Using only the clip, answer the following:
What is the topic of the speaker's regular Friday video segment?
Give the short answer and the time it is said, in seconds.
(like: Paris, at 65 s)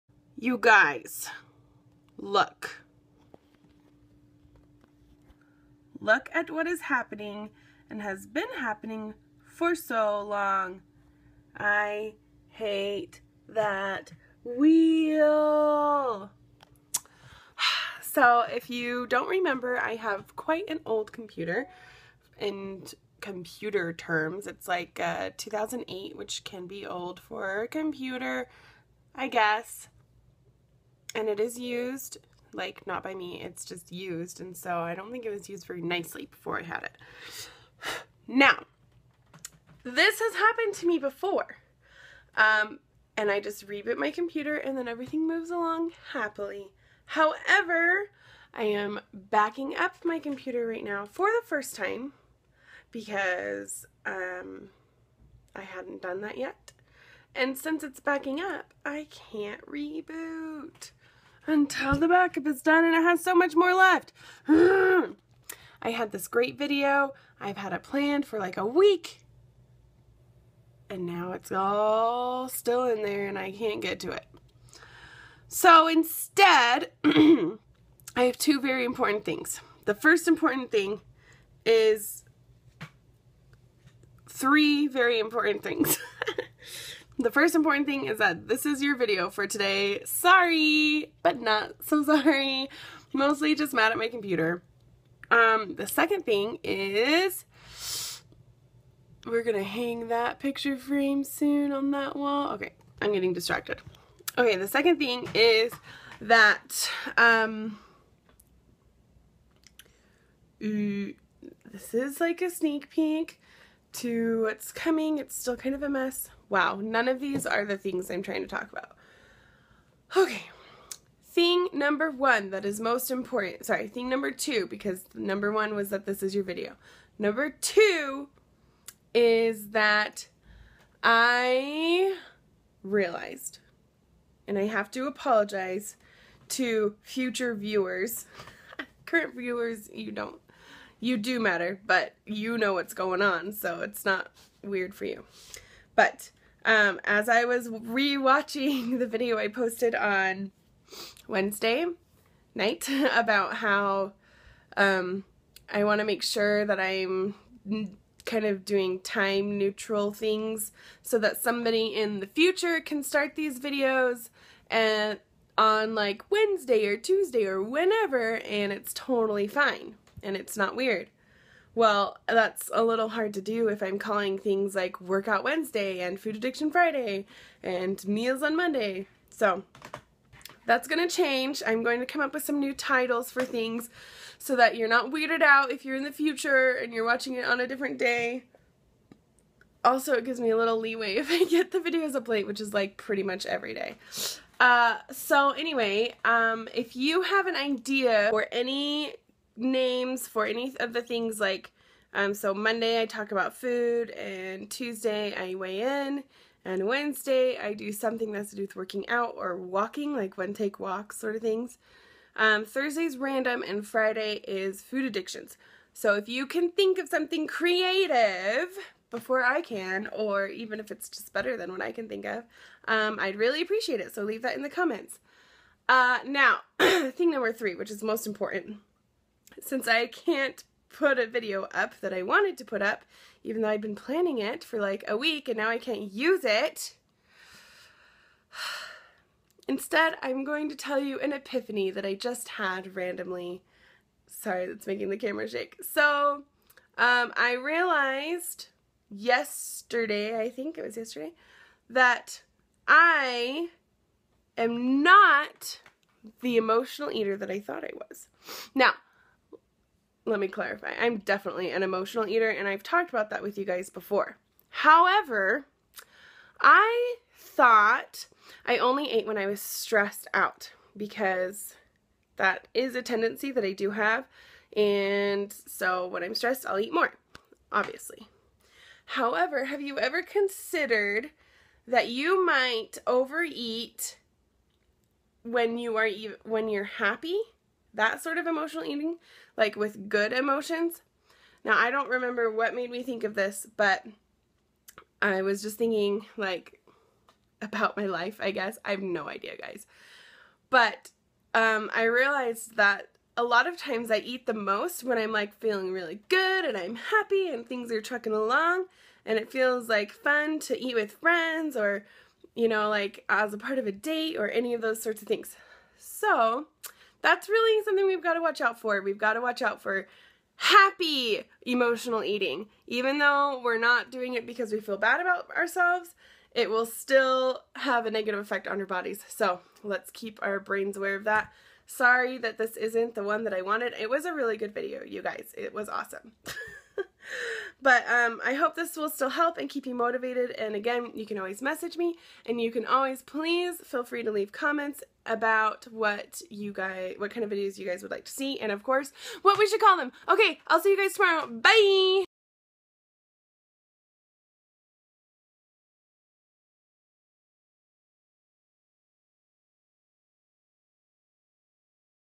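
food addictions, at 214 s.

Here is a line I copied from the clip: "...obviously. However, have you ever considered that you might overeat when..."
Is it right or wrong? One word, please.
right.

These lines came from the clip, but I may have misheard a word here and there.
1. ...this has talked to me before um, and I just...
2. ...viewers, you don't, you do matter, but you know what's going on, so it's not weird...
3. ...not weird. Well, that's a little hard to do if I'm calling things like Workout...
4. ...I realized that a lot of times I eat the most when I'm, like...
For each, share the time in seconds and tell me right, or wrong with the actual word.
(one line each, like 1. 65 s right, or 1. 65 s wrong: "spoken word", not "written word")
1. 39 s wrong: "happened", not "talked"
2. 139 s right
3. 170 s right
4. 301 s right.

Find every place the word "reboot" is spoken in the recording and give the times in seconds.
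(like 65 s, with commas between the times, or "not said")
43 s, 59 s.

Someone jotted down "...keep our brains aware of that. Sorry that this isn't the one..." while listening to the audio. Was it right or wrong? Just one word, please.
right.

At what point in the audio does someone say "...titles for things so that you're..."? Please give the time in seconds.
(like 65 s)
182 s.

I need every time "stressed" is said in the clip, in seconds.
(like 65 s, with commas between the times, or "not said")
269 s, 276 s.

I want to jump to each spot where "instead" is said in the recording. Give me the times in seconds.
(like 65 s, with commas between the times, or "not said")
75 s, 239 s.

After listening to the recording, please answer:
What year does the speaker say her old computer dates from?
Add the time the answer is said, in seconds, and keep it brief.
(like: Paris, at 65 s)
2008, at 25 s.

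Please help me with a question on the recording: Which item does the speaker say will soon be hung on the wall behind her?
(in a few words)
picture frame.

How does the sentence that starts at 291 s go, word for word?
Now, I don't remember what made me think of this, but I was just thinking, like, about my life, I guess.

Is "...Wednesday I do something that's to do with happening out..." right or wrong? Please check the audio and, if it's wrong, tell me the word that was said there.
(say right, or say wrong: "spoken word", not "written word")
wrong: "working", not "happening".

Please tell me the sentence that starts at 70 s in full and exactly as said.
And now it's all still in there and I can't get to it.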